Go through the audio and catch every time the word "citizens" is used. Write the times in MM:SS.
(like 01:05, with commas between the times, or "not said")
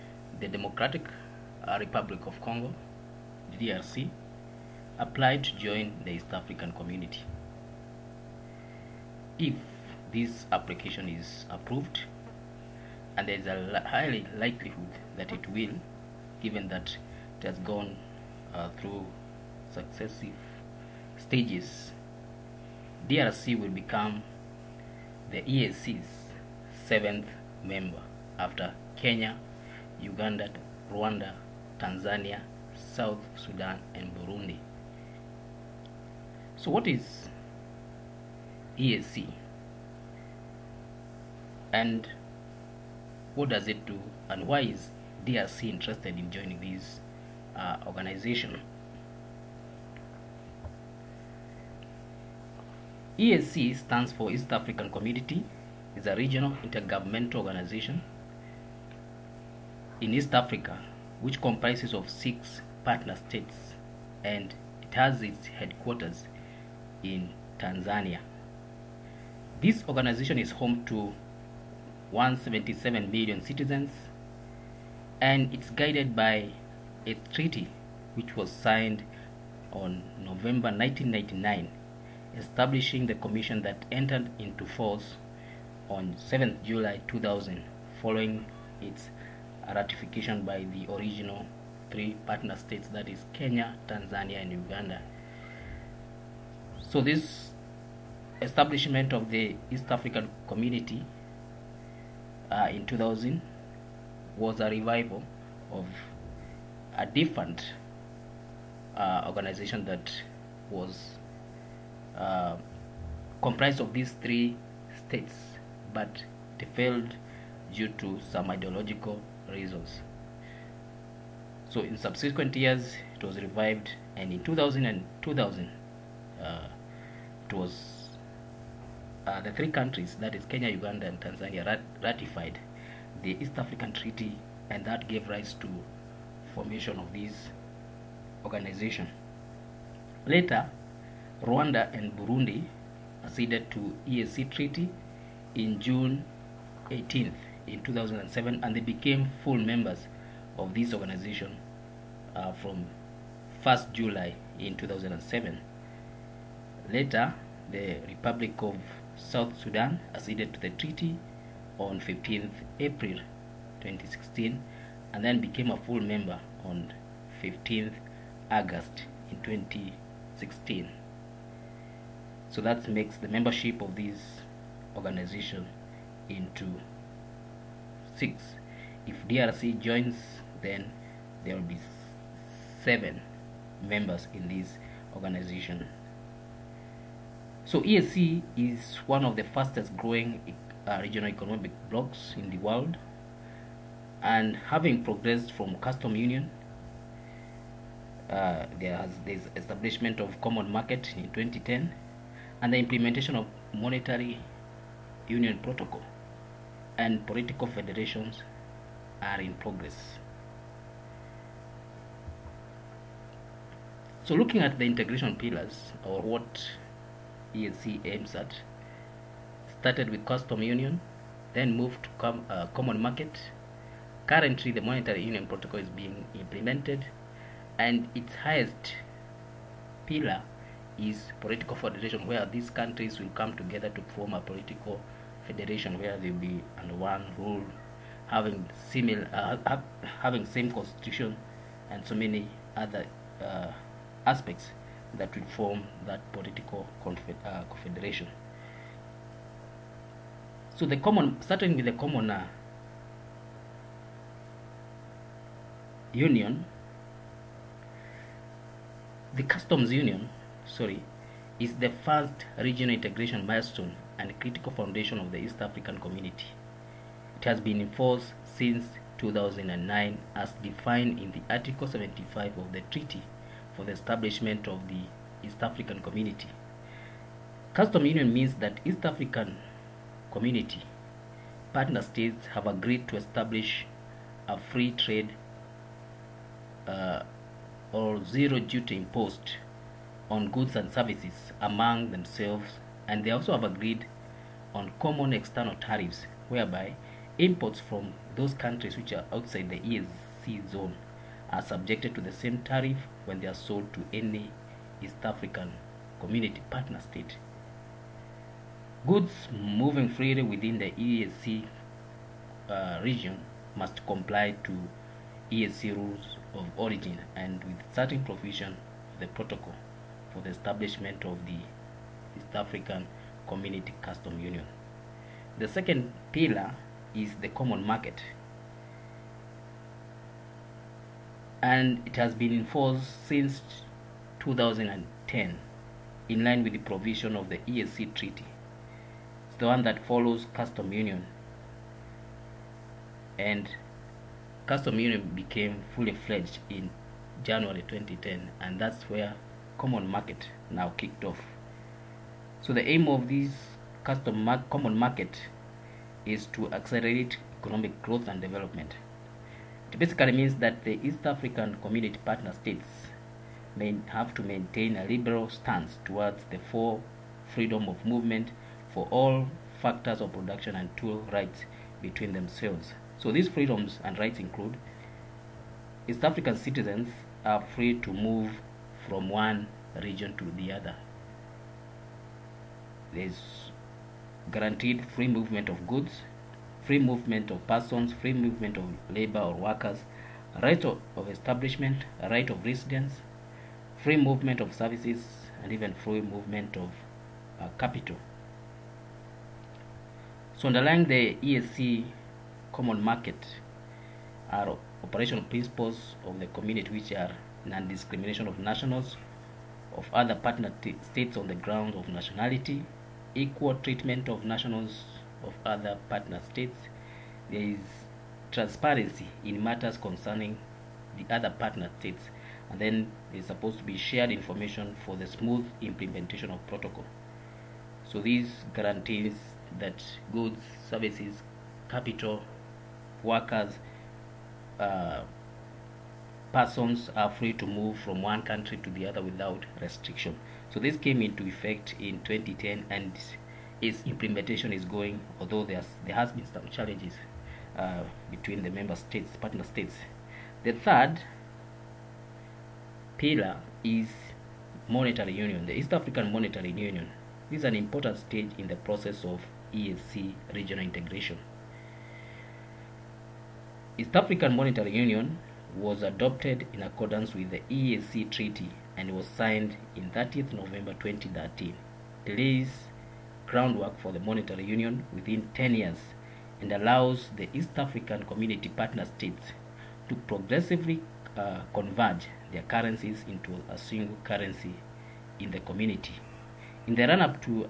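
01:13, 06:16.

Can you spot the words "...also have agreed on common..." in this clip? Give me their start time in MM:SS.
04:53.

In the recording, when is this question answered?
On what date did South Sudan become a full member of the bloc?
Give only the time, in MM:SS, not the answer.
02:47.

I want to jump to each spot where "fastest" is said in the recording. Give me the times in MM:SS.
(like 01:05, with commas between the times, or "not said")
03:09.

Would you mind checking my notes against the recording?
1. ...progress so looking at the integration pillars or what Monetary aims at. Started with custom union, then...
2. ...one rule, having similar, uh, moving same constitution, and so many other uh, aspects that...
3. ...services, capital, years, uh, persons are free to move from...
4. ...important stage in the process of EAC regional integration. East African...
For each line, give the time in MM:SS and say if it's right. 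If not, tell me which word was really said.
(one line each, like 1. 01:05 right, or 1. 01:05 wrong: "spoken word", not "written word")
1. 03:29 wrong: "EAC", not "Monetary"
2. 03:56 wrong: "having", not "moving"
3. 07:10 wrong: "workers", not "years"
4. 07:37 right.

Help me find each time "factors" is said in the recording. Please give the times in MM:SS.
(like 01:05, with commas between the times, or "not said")
06:09.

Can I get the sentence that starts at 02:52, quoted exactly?
So that makes the membership of this organization into 6.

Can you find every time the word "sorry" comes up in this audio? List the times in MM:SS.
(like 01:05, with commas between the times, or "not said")
04:20.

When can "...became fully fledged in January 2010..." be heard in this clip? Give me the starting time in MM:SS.
05:45.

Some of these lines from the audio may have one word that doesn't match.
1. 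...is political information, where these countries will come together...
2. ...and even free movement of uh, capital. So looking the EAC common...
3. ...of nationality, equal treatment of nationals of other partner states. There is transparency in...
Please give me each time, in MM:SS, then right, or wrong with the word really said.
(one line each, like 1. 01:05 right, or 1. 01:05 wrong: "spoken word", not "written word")
1. 03:50 wrong: "federation", not "information"
2. 06:35 wrong: "underlying", not "looking"
3. 06:51 right.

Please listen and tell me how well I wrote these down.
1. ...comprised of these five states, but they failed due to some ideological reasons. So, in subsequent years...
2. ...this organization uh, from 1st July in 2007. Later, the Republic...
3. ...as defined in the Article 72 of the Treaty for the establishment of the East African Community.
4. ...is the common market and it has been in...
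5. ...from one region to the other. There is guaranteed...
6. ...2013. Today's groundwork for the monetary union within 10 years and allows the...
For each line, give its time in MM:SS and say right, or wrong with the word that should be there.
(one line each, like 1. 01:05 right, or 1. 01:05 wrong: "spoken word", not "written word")
1. 01:53 wrong: "three", not "five"
2. 02:30 right
3. 04:30 wrong: "75", not "72"
4. 05:27 right
5. 06:19 right
6. 07:51 right.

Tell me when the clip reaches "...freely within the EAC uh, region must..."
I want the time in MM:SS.
05:10.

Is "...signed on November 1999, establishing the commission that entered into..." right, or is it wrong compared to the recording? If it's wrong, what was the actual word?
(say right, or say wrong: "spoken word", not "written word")
right.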